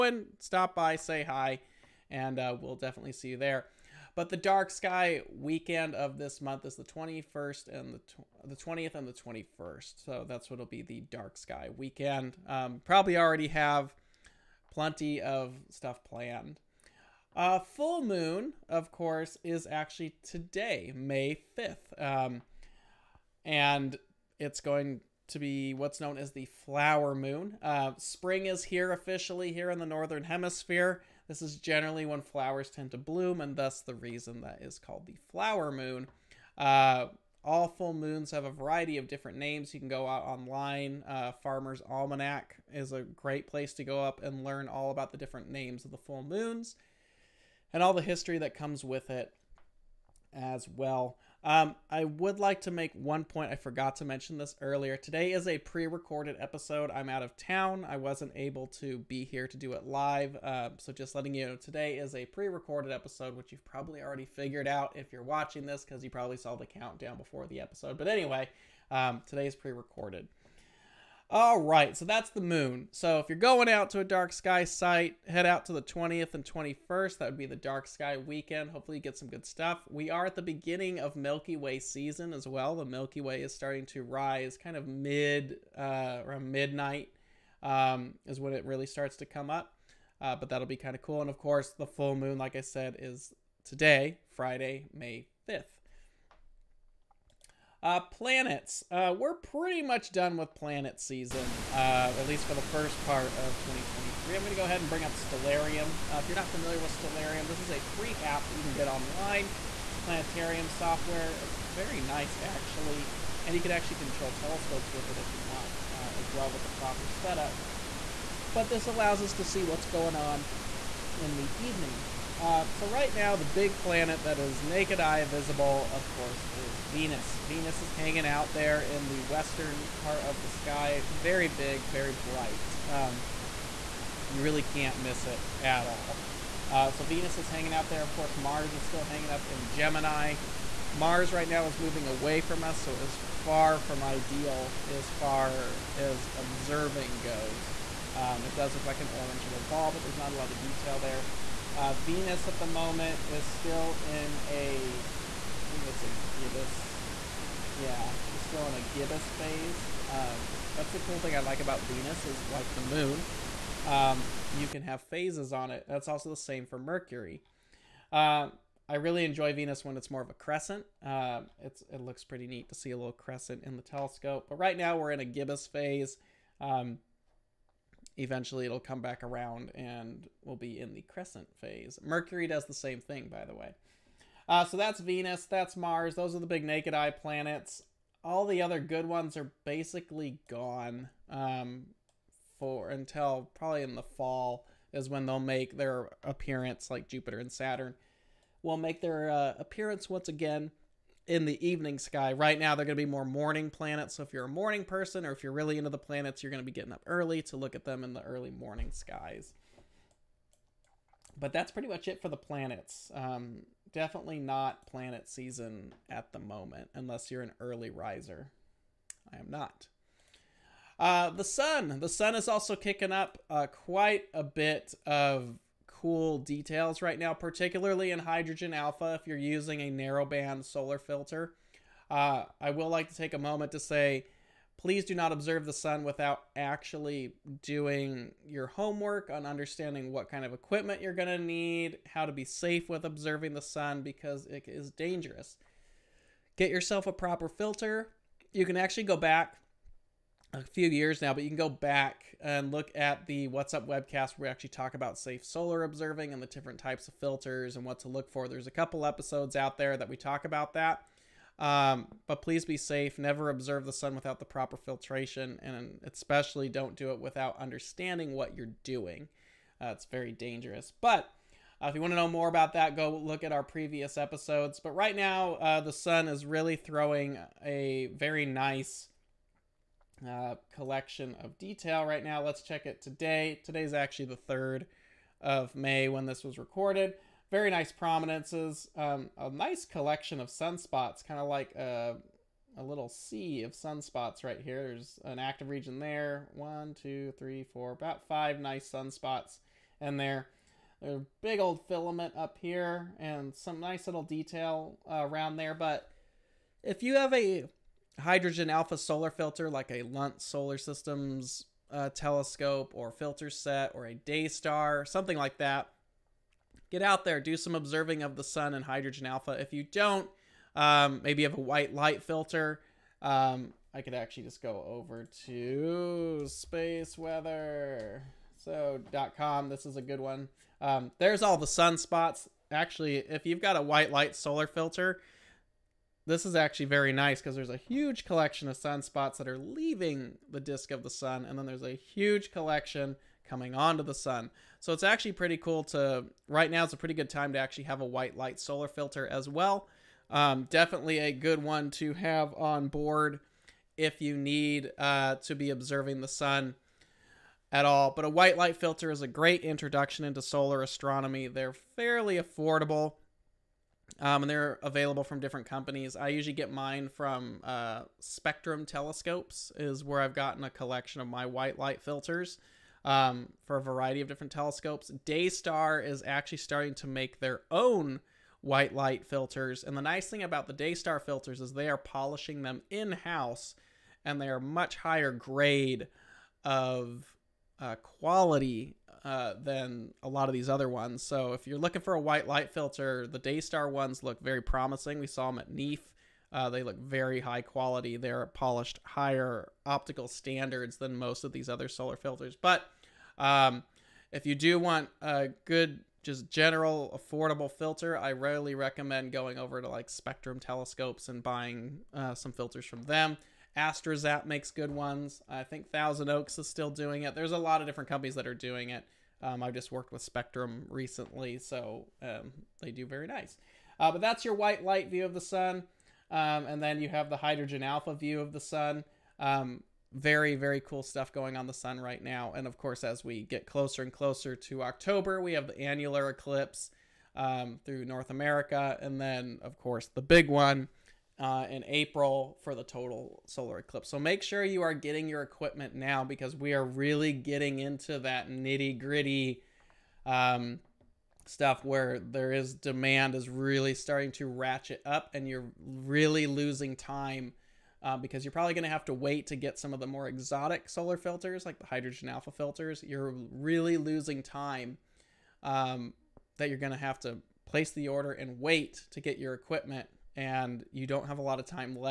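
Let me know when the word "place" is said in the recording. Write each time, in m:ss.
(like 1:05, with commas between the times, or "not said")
0:43, 7:47.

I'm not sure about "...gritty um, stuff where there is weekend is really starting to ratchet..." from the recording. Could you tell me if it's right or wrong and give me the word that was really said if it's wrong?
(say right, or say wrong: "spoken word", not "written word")
wrong: "demand", not "weekend".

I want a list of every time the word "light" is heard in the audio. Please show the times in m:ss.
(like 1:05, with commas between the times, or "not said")
5:21, 5:34, 5:48, 5:58, 6:11, 6:18, 6:32, 7:04.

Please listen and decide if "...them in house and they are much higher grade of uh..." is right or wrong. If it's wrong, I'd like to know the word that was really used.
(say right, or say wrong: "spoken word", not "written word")
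right.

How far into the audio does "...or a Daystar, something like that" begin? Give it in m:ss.
5:13.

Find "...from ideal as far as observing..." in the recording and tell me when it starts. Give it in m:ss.
2:23.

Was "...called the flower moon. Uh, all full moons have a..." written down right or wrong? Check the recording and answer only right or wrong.
right.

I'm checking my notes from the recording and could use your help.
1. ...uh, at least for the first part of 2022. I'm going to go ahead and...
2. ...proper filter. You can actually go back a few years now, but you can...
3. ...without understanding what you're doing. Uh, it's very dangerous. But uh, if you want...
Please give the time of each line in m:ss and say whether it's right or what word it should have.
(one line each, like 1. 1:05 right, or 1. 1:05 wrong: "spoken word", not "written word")
1. 1:41 wrong: "2023", not "2022"
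2. 4:07 right
3. 4:27 right.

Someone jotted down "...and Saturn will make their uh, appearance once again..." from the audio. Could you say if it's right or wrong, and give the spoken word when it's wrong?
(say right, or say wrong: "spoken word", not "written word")
right.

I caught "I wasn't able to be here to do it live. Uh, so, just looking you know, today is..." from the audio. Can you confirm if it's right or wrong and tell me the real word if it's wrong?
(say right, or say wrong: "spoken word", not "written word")
wrong: "letting", not "looking".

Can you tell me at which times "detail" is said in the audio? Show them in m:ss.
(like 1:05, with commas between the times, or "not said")
2:30, 3:46, 4:41, 5:04.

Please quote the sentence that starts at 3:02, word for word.
Mercury does the same thing, by the way.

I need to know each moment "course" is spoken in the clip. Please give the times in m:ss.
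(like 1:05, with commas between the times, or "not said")
0:18, 1:31, 2:06, 2:18, 7:12, 7:19.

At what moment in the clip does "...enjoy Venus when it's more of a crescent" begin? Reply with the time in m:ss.
2:49.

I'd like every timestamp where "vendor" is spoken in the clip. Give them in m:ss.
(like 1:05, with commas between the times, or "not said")
not said.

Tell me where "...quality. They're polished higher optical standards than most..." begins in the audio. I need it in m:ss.
6:37.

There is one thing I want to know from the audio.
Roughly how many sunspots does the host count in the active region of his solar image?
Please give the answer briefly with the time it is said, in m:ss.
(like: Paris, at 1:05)
5, at 4:58.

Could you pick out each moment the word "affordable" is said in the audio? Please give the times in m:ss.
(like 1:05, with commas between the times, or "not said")
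6:02, 6:47.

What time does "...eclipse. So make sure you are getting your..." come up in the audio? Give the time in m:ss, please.
7:23.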